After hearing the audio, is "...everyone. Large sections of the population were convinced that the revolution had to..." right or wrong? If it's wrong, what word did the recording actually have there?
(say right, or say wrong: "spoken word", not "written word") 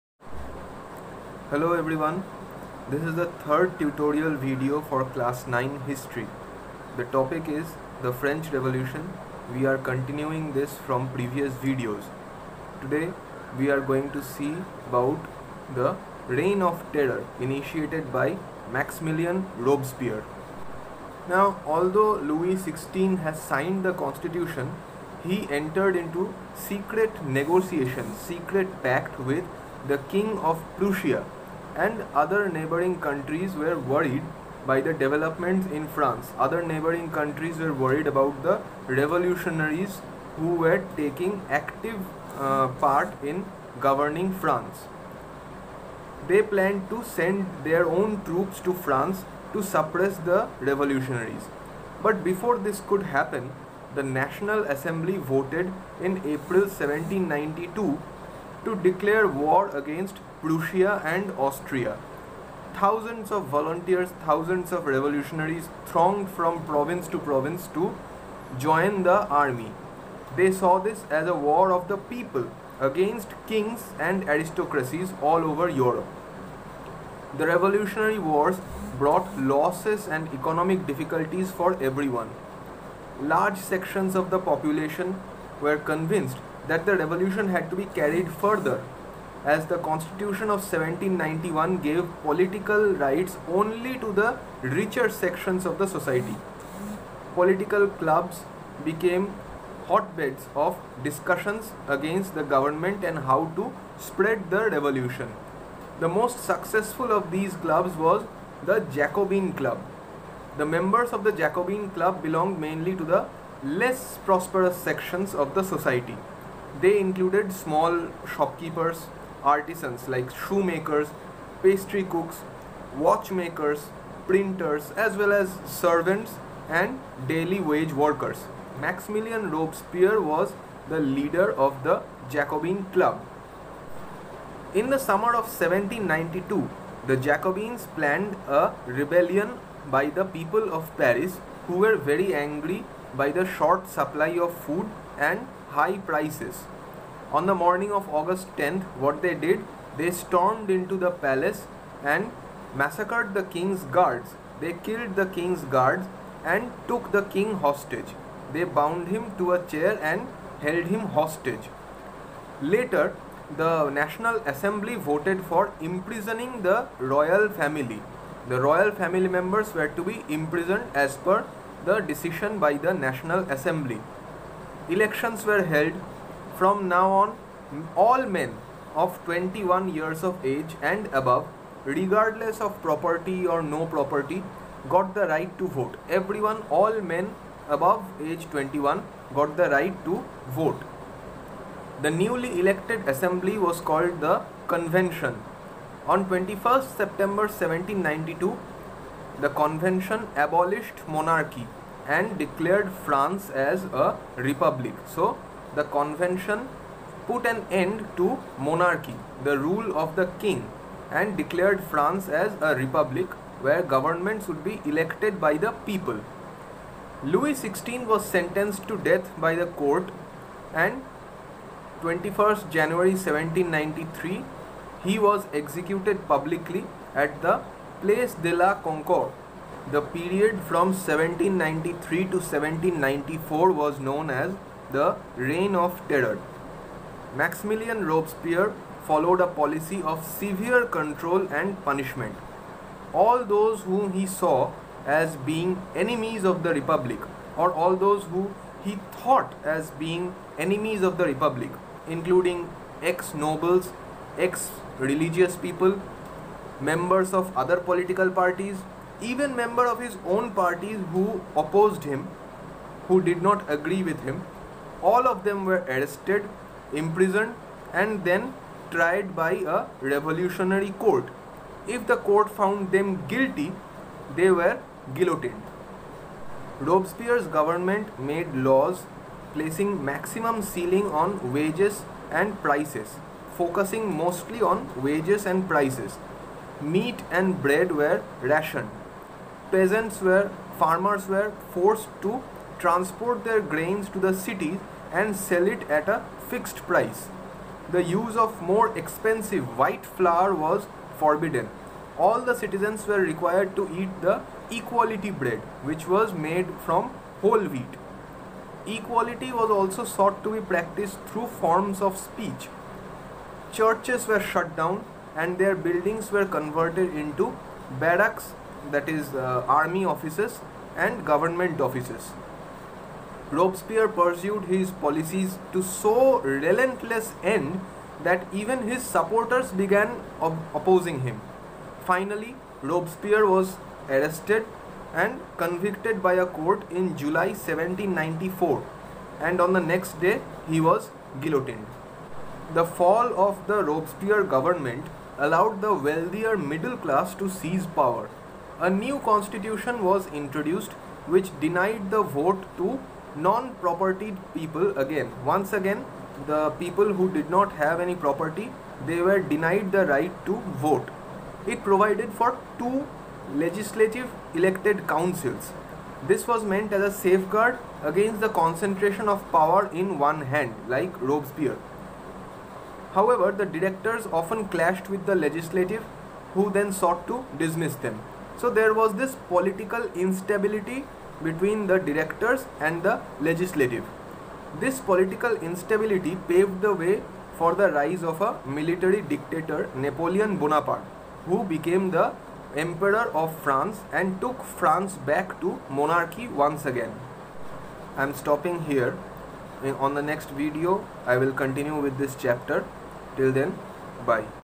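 right.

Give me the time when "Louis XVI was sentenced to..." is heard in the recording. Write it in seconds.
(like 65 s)
217 s.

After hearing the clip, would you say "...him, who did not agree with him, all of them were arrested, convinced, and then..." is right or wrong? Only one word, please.
wrong.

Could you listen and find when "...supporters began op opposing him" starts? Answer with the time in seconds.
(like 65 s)
329 s.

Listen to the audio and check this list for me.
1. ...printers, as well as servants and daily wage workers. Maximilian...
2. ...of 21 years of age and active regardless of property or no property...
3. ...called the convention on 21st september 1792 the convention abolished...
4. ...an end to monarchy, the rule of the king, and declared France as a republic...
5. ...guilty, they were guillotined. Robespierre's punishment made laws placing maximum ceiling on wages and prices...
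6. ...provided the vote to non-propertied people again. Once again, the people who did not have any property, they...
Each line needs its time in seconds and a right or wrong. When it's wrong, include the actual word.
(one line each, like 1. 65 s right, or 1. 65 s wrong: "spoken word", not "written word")
1. 124 s right
2. 178 s wrong: "above", not "active"
3. 193 s right
4. 207 s right
5. 273 s wrong: "government", not "punishment"
6. 351 s wrong: "denied", not "provided".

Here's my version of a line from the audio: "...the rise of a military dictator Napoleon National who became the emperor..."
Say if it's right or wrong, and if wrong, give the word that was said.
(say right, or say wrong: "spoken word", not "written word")
wrong: "Bonaparte", not "National".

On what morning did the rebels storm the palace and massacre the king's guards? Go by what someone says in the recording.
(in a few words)
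August 10th.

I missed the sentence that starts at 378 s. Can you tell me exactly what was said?
So there was this political instability between the directors and the legislative.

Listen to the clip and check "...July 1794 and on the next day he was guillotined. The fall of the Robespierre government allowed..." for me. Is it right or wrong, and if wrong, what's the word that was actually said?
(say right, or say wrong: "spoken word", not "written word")
right.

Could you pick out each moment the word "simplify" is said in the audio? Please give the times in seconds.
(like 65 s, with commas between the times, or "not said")
not said.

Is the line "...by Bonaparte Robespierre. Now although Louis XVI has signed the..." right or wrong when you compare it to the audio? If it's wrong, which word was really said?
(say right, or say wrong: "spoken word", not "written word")
wrong: "Maximilian", not "Bonaparte".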